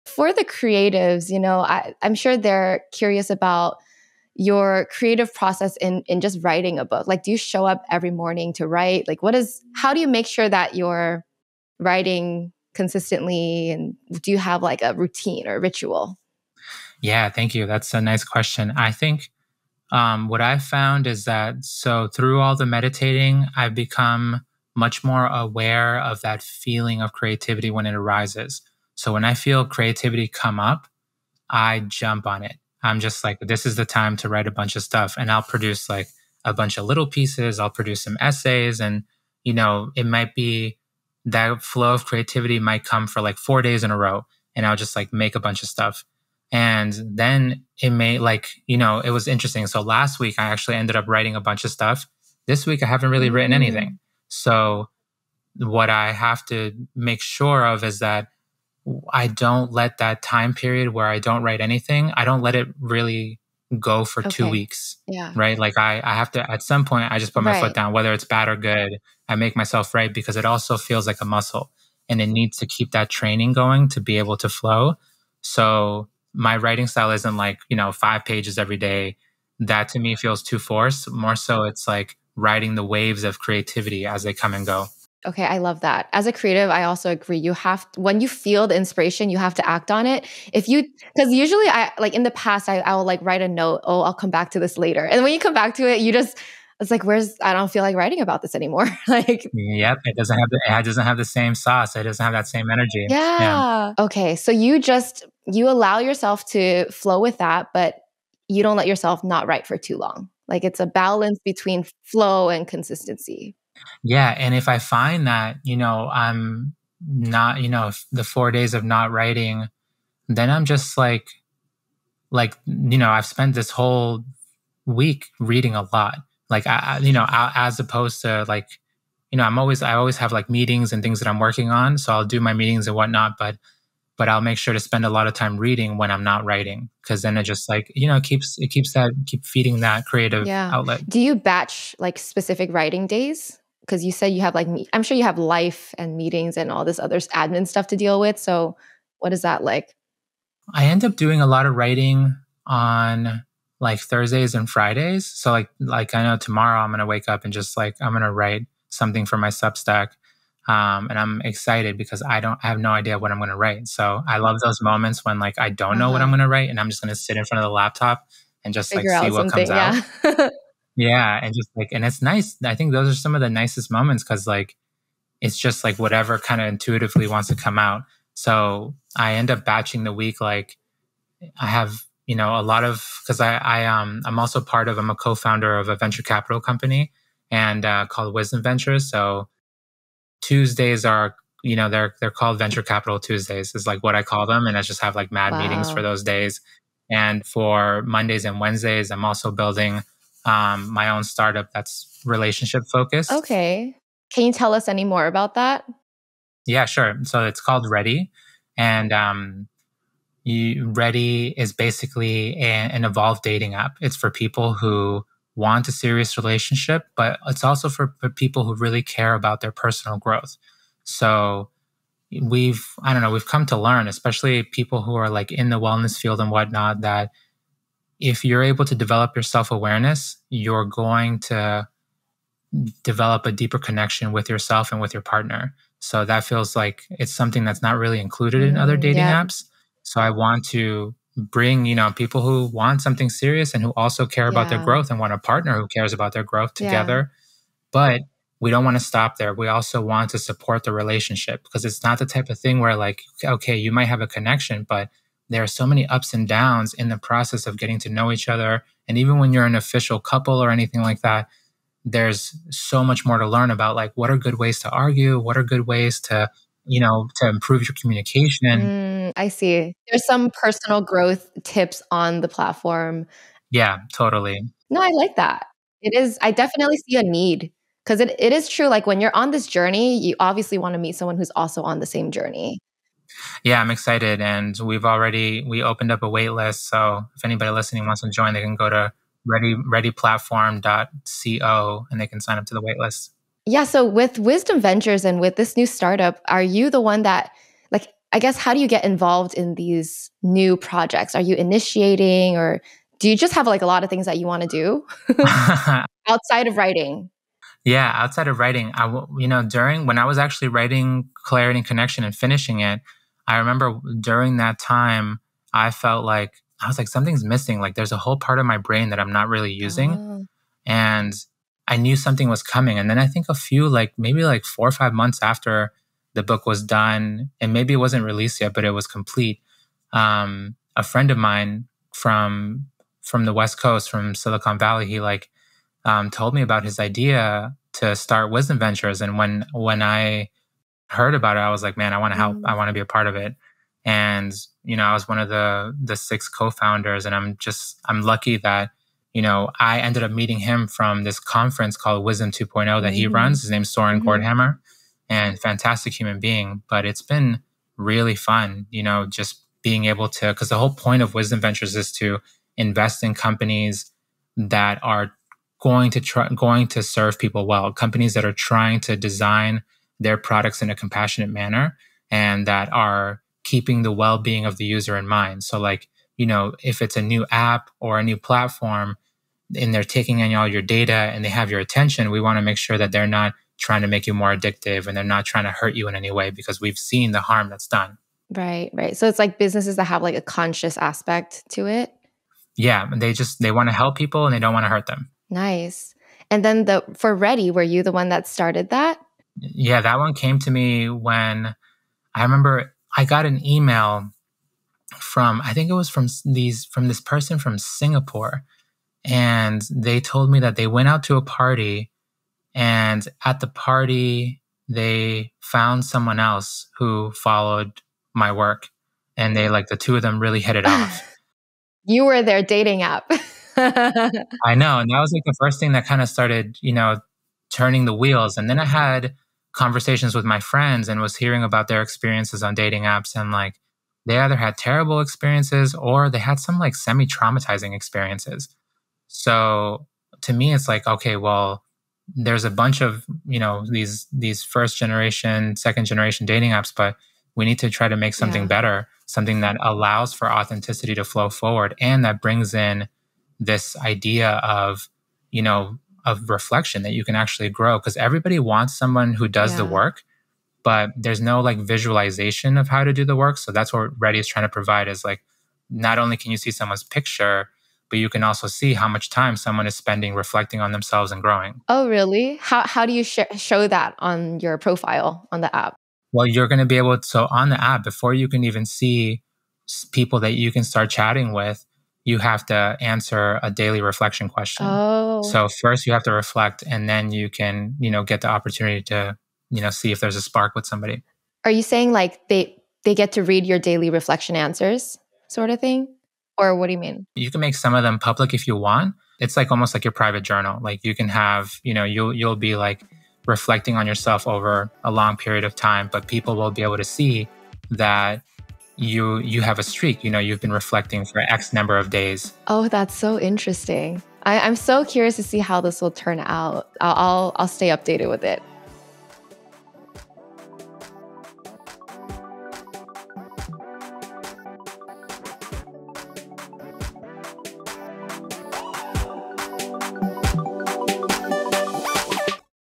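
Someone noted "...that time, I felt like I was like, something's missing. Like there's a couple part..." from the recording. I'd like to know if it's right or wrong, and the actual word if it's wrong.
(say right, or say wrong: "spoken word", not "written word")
wrong: "whole", not "couple".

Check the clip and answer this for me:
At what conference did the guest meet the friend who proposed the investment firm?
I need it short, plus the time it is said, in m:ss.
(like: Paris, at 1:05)
Wisdom 2.0, at 5:52.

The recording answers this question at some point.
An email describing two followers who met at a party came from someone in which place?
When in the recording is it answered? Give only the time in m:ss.
6:47.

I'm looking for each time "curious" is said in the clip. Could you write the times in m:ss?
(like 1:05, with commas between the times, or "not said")
0:02, 8:35.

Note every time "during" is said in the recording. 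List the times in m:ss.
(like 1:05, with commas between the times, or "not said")
5:09, 5:14.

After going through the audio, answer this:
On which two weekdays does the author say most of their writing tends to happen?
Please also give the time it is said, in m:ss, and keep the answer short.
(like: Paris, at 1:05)
Thursdays and Fridays, at 2:33.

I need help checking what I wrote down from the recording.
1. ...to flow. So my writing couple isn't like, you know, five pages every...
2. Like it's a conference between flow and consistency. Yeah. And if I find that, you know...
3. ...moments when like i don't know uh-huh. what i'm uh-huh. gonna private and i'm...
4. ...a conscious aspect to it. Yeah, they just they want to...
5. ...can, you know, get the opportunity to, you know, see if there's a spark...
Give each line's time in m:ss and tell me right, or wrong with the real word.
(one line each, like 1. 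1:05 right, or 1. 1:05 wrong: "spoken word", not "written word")
1. 1:14 wrong: "style", not "couple"
2. 1:50 wrong: "balance", not "conference"
3. 2:44 wrong: "write", not "private"
4. 6:30 right
5. 8:07 right.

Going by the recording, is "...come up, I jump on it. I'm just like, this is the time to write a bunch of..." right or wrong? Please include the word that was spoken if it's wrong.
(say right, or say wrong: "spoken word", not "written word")
right.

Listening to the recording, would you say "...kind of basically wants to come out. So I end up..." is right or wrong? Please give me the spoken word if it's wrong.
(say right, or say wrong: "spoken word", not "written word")
wrong: "intuitively", not "basically".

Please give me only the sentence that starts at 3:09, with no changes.
So Tuesdays are, you know, they're, they're called venture capital Tuesdays is like what I call them.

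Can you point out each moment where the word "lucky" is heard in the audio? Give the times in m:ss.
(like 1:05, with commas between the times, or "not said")
5:48.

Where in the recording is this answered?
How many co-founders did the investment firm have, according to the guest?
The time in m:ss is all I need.
5:46.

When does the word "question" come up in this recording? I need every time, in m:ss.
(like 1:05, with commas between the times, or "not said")
0:18, 8:04.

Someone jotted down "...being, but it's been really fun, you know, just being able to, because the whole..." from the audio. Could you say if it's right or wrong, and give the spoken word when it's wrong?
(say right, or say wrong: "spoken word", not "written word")
right.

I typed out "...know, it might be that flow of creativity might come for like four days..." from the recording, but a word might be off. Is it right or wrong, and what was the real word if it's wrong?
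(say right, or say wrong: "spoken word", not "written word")
right.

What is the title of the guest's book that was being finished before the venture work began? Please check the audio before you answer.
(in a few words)
Clarity and Connection.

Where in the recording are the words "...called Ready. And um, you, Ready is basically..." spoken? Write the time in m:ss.
3:27.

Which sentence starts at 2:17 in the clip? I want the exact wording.
Cause then it just like, you know, it keeps, it keeps that, keep feeding that creative yeah.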